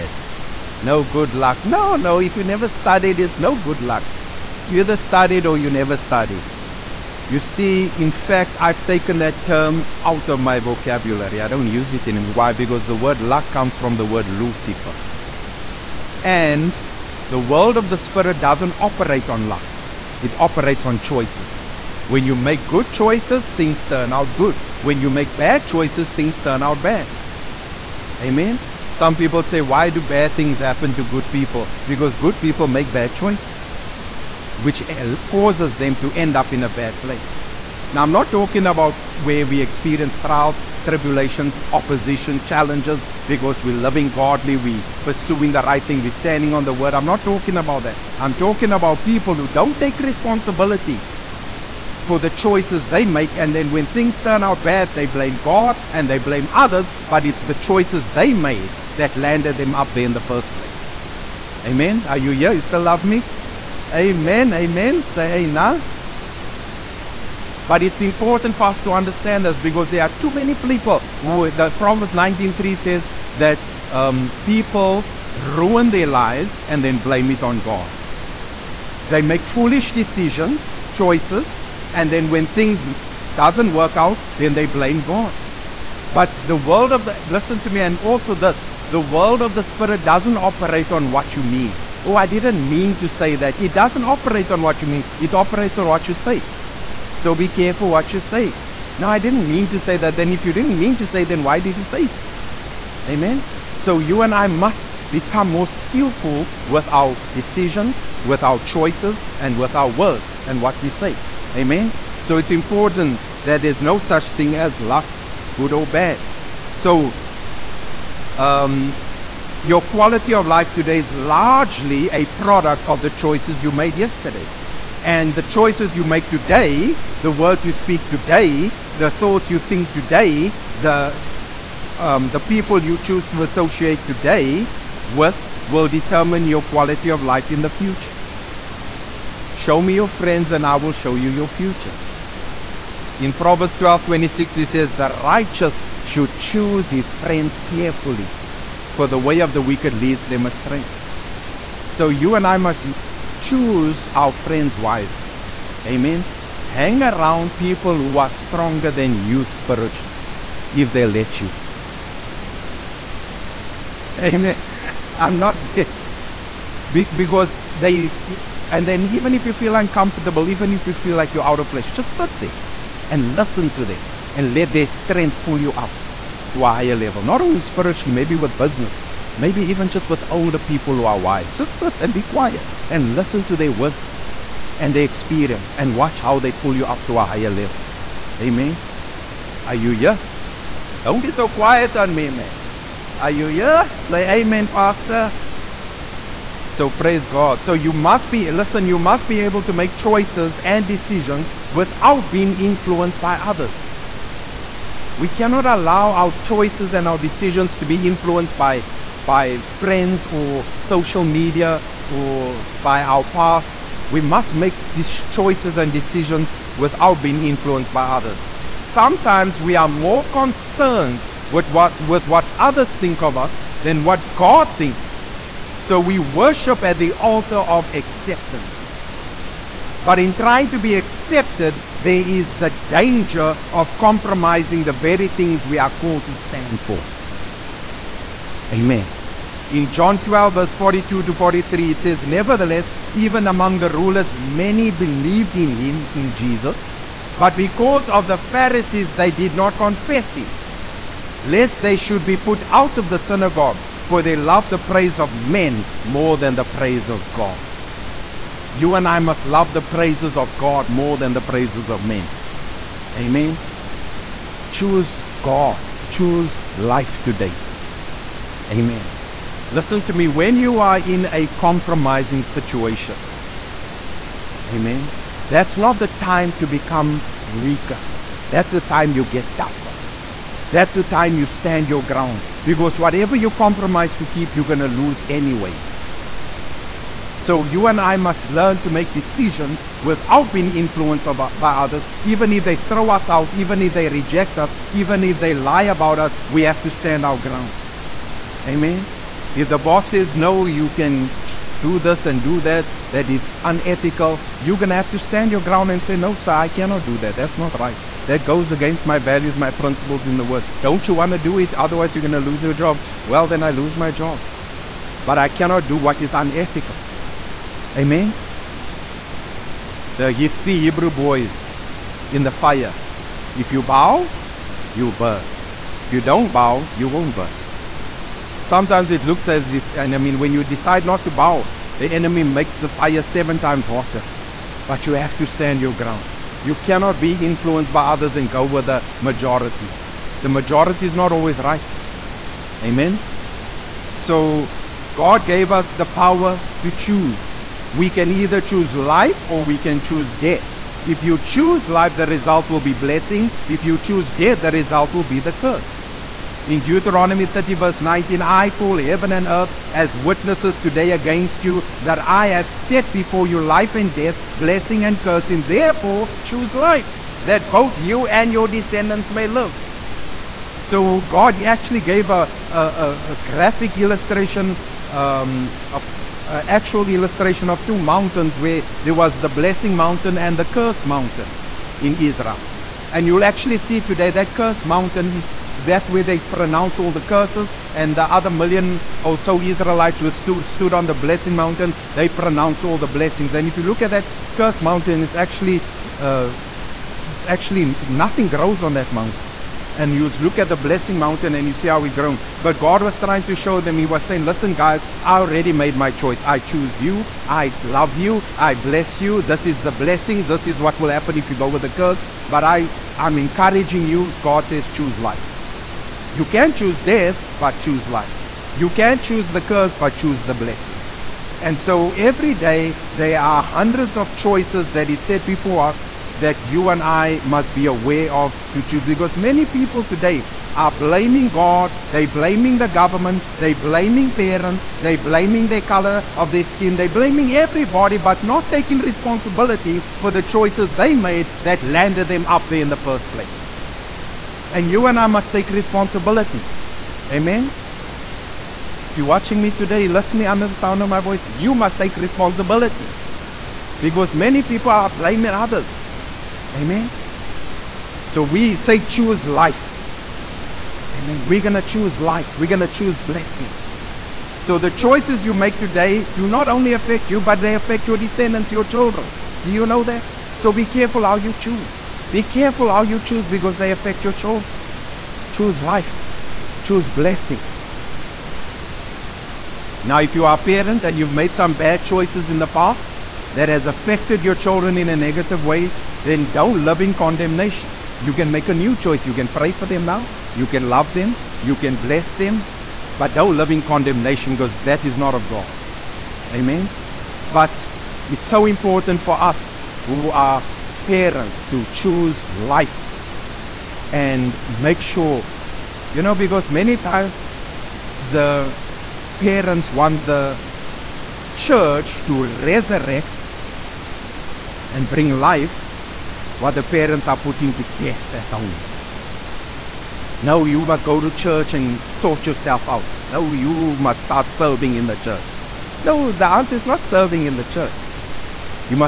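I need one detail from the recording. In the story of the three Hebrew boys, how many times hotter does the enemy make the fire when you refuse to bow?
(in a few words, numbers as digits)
7 times.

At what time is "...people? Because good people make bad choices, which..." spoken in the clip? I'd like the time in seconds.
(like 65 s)
31 s.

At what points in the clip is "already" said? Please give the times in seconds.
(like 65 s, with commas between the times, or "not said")
405 s.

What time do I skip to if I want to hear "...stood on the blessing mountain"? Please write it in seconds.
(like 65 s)
390 s.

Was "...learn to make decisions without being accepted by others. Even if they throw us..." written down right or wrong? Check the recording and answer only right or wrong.
wrong.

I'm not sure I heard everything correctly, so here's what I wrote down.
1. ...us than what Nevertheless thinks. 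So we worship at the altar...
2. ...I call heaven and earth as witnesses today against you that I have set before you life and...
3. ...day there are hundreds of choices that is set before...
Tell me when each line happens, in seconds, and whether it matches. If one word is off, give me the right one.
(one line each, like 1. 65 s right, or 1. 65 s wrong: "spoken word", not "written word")
1. 223 s wrong: "God", not "Nevertheless"
2. 358 s right
3. 422 s right.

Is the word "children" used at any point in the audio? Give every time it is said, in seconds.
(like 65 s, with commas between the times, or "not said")
468 s, 474 s, 484 s.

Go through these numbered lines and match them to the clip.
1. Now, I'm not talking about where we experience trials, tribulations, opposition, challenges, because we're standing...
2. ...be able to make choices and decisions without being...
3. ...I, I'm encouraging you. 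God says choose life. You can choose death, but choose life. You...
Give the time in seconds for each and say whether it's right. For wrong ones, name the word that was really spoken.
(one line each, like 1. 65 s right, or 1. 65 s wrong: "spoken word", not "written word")
1. 37 s wrong: "loving", not "standing"
2. 199 s right
3. 412 s right.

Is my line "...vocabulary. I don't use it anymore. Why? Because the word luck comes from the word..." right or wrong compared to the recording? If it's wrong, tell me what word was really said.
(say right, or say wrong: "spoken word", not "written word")
right.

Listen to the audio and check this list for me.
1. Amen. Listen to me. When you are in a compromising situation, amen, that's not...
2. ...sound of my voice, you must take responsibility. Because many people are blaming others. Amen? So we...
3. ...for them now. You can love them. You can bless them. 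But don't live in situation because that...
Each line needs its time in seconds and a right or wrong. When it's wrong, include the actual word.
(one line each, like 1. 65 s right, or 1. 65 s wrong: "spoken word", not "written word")
1. 268 s right
2. 450 s right
3. 489 s wrong: "condemnation", not "situation".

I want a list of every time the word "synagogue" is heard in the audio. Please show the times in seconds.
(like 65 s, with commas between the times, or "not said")
253 s.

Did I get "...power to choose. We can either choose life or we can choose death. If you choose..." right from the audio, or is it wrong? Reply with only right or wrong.
right.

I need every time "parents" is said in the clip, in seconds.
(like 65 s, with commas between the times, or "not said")
434 s, 480 s, 501 s, 509 s, 516 s.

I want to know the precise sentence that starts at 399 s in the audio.
And you look at the blessing mountain and you see how it grown.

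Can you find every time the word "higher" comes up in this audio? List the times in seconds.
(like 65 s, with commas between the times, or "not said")
176 s, 187 s.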